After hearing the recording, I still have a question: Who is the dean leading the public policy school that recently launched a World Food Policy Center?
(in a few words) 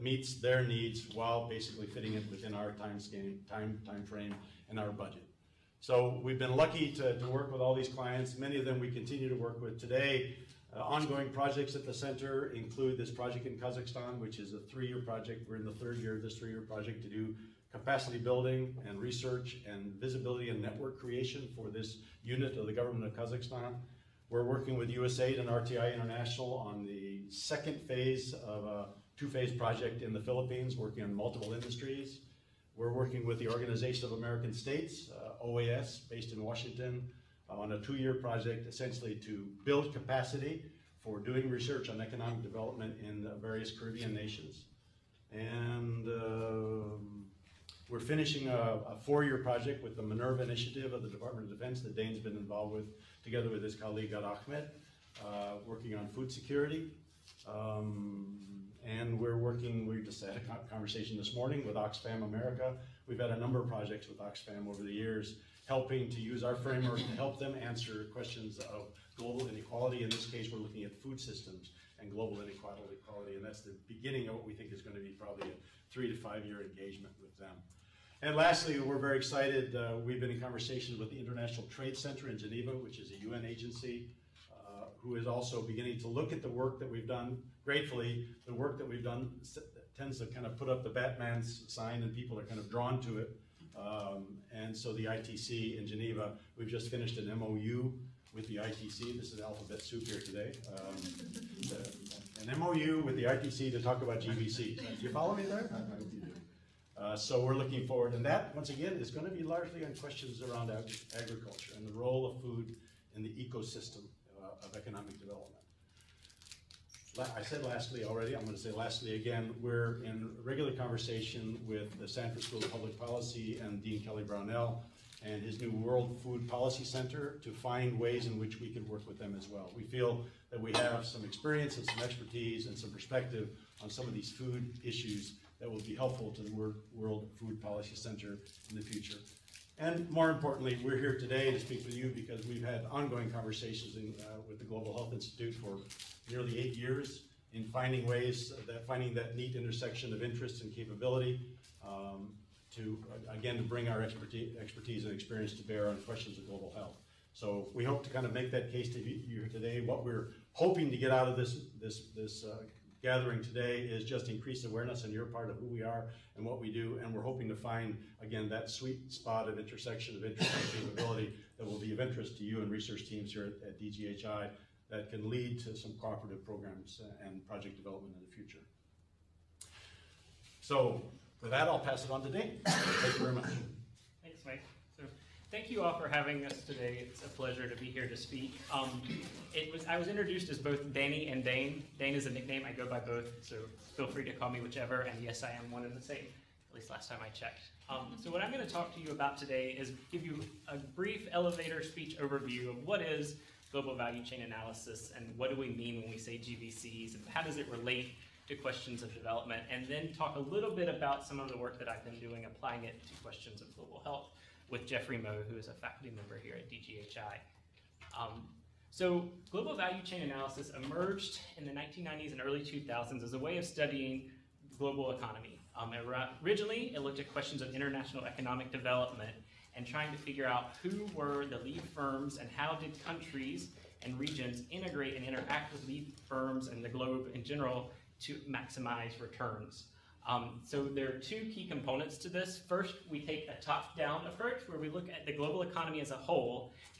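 Kelly Brownell.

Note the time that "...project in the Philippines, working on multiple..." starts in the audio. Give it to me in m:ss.
0:29.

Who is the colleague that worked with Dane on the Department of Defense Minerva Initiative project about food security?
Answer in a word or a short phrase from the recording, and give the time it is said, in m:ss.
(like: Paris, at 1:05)
Ad Ahmed, at 0:54.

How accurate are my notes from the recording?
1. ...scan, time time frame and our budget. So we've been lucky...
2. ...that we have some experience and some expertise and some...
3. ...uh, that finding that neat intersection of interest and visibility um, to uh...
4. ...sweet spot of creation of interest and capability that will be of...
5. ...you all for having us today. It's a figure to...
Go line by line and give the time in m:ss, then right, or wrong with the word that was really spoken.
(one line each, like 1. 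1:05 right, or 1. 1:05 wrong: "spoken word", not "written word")
1. 0:02 right
2. 2:10 right
3. 2:28 wrong: "capability", not "visibility"
4. 2:48 wrong: "intersection", not "creation"
5. 3:05 wrong: "pleasure", not "figure".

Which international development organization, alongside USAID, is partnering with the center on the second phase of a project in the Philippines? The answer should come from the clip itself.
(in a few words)
RTI International.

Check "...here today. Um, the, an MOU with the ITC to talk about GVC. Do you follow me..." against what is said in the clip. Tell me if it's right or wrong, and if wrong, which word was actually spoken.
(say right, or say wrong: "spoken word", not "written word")
right.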